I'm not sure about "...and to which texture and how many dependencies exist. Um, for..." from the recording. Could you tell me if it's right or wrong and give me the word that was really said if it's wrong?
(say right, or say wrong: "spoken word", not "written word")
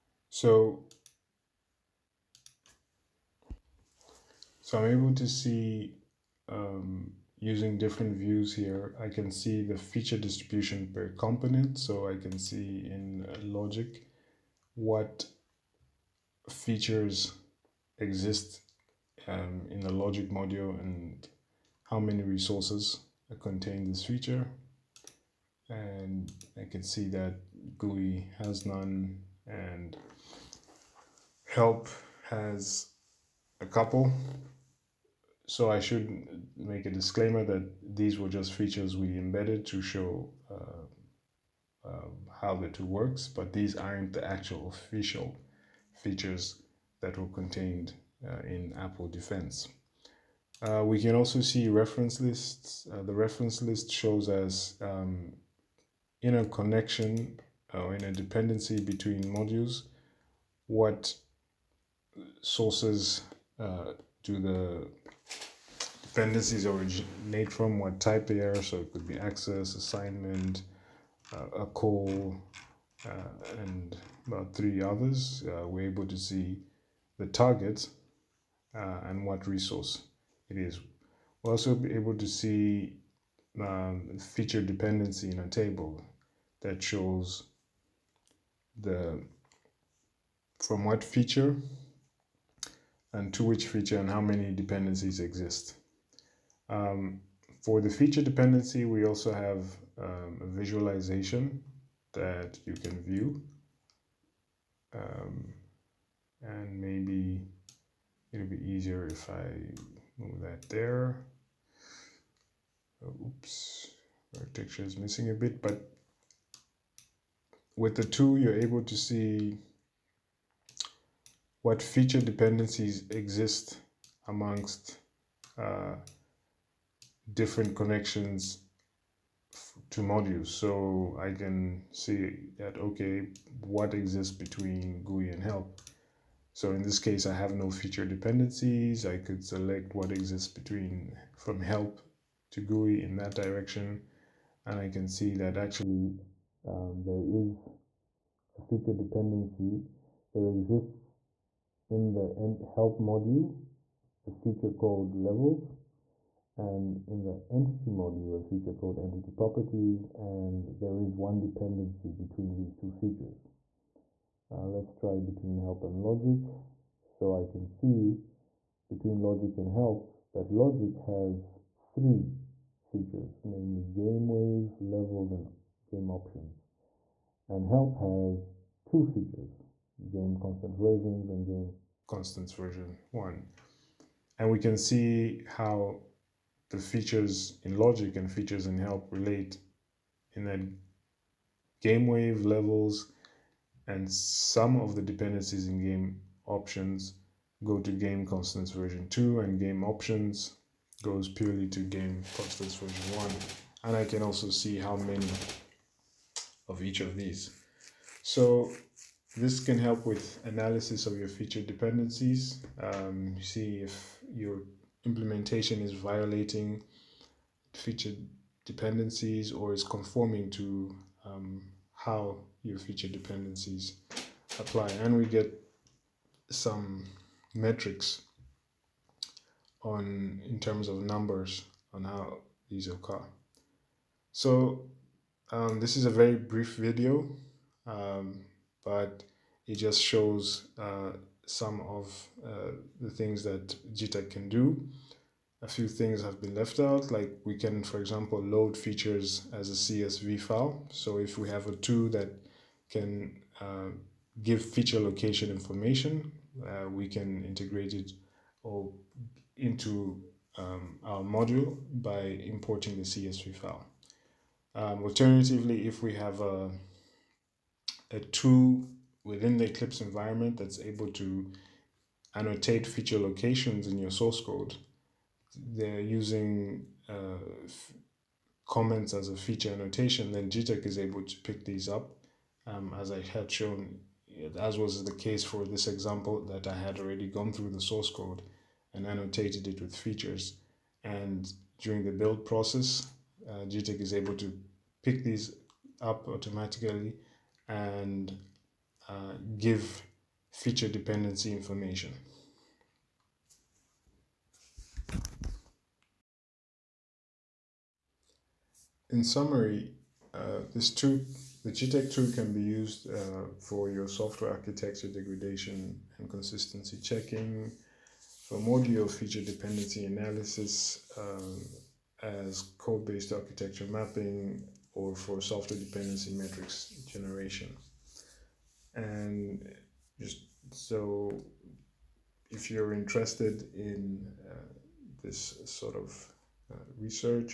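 wrong: "feature", not "texture".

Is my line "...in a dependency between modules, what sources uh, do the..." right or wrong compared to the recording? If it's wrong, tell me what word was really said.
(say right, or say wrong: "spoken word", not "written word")
right.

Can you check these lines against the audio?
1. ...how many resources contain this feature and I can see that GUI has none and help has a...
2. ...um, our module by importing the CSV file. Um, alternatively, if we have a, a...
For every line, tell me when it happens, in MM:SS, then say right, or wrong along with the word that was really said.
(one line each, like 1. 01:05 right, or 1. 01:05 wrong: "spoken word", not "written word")
1. 00:21 right
2. 04:20 right.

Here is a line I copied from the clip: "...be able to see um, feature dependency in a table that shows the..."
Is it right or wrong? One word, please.
right.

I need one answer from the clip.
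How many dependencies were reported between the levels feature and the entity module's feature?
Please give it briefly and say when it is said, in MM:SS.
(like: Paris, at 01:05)
1, at 02:41.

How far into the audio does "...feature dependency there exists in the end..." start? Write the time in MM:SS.
02:28.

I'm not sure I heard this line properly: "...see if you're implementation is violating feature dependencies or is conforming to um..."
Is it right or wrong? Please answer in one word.
right.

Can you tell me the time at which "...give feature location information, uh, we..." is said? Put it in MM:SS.
04:14.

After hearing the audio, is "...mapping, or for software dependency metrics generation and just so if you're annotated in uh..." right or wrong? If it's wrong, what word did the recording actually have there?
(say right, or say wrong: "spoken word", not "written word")
wrong: "interested", not "annotated".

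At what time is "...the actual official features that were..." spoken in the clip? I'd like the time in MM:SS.
00:44.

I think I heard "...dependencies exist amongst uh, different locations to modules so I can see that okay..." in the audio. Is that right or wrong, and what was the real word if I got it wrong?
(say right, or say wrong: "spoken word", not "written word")
wrong: "connections", not "locations".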